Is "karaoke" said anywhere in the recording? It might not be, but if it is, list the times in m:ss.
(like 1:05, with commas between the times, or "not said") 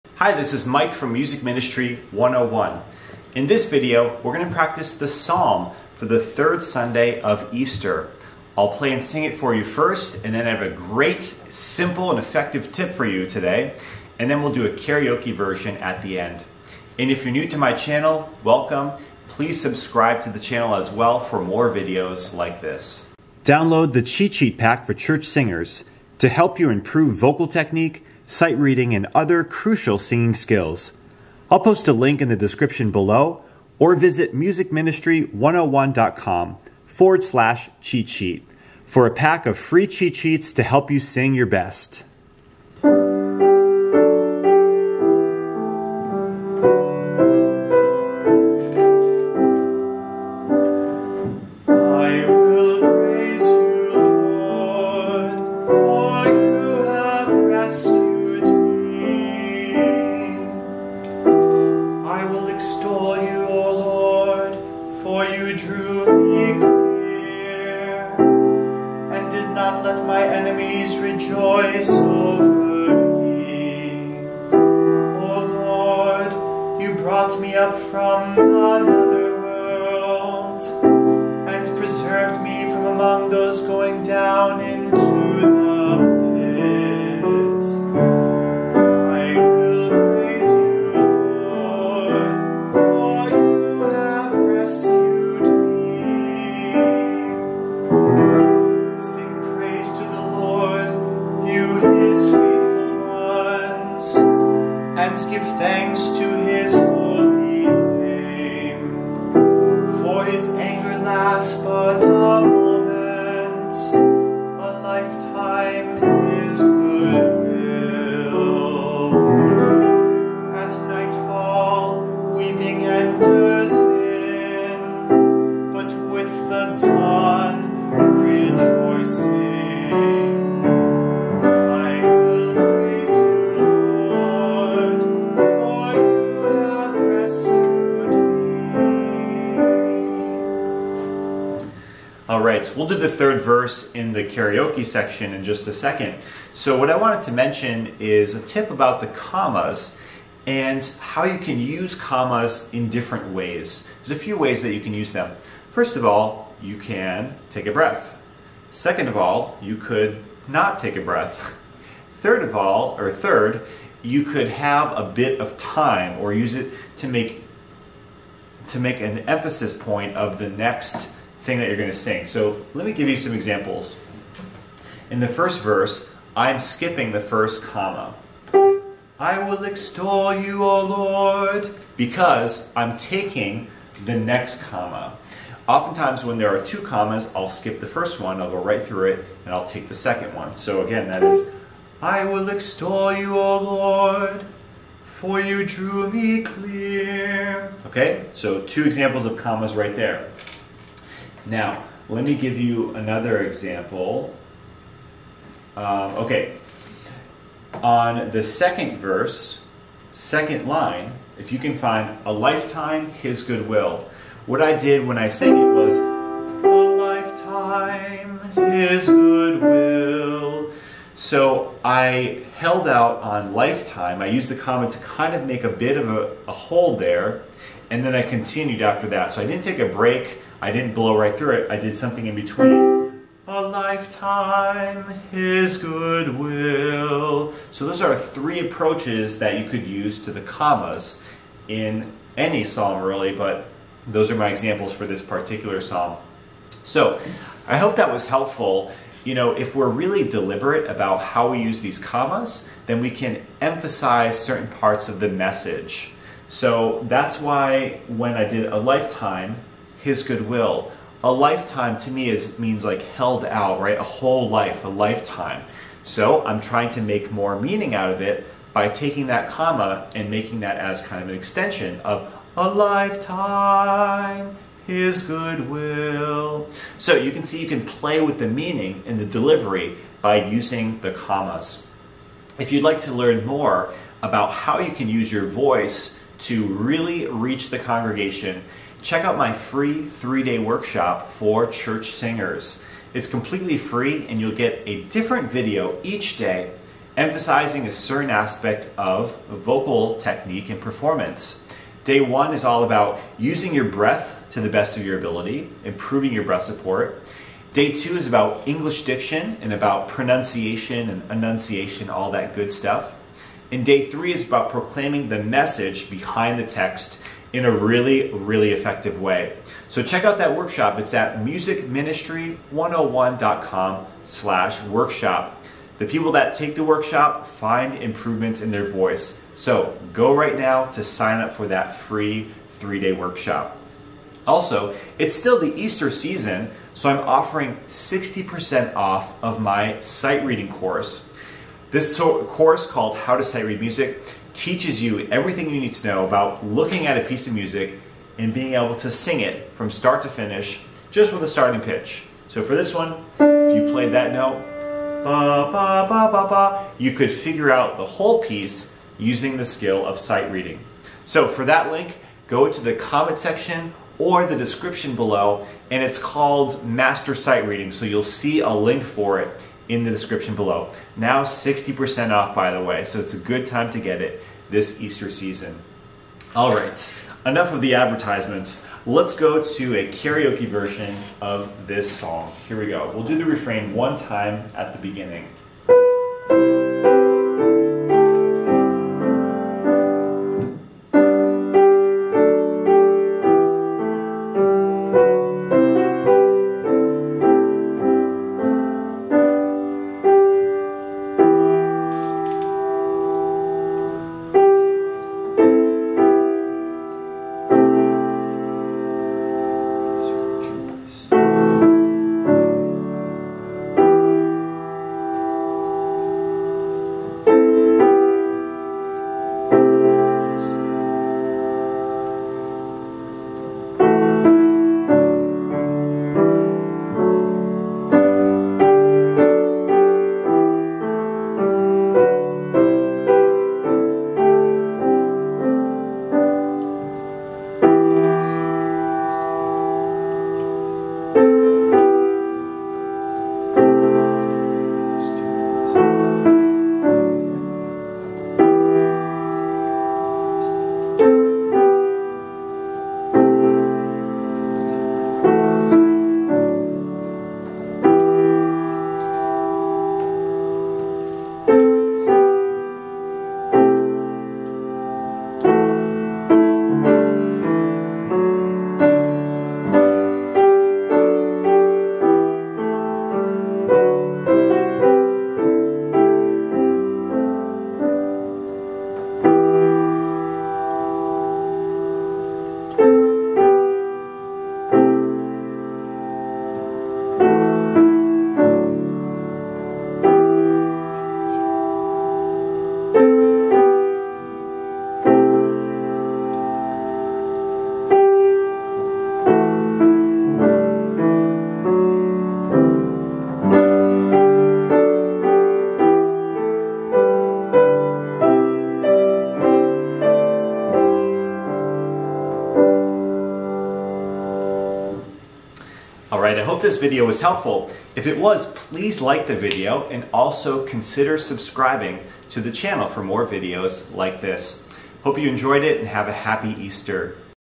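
0:14, 2:24, 6:20.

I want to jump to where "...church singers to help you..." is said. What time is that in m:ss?
0:24.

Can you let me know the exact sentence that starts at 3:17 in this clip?
Okay, so two examples of commas right there.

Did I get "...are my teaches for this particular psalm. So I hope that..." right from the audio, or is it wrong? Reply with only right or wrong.
wrong.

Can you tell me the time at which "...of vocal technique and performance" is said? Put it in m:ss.
4:58.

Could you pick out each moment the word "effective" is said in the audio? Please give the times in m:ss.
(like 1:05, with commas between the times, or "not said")
0:12, 5:18.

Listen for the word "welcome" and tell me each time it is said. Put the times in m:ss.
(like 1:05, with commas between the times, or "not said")
0:18.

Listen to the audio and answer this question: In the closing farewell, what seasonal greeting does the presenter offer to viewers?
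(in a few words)
Happy Easter.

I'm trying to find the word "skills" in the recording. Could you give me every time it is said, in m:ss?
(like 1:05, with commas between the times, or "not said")
0:30, 5:59.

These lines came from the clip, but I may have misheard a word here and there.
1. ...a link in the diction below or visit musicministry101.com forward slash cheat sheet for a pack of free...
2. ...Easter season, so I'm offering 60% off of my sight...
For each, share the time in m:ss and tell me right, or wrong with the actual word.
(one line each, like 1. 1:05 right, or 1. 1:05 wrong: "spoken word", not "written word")
1. 0:31 wrong: "description", not "diction"
2. 5:35 right.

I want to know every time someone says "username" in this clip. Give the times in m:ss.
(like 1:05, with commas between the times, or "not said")
not said.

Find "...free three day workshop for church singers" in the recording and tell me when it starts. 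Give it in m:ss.
4:49.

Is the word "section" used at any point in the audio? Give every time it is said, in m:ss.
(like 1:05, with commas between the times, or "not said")
2:24, 6:03.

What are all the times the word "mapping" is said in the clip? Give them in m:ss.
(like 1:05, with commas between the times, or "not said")
not said.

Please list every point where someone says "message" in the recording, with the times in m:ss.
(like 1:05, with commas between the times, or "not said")
4:15, 5:15.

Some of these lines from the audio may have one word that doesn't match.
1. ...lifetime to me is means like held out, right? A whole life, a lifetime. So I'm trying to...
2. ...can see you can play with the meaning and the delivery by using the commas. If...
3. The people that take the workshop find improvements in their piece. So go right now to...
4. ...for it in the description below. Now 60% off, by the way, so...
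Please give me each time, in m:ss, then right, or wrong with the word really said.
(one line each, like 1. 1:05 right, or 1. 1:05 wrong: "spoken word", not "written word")
1. 4:21 right
2. 4:37 right
3. 5:25 wrong: "voice", not "piece"
4. 6:09 right.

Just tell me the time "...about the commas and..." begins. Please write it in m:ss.
2:28.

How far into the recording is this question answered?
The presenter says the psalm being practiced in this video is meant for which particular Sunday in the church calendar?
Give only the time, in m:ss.
0:06.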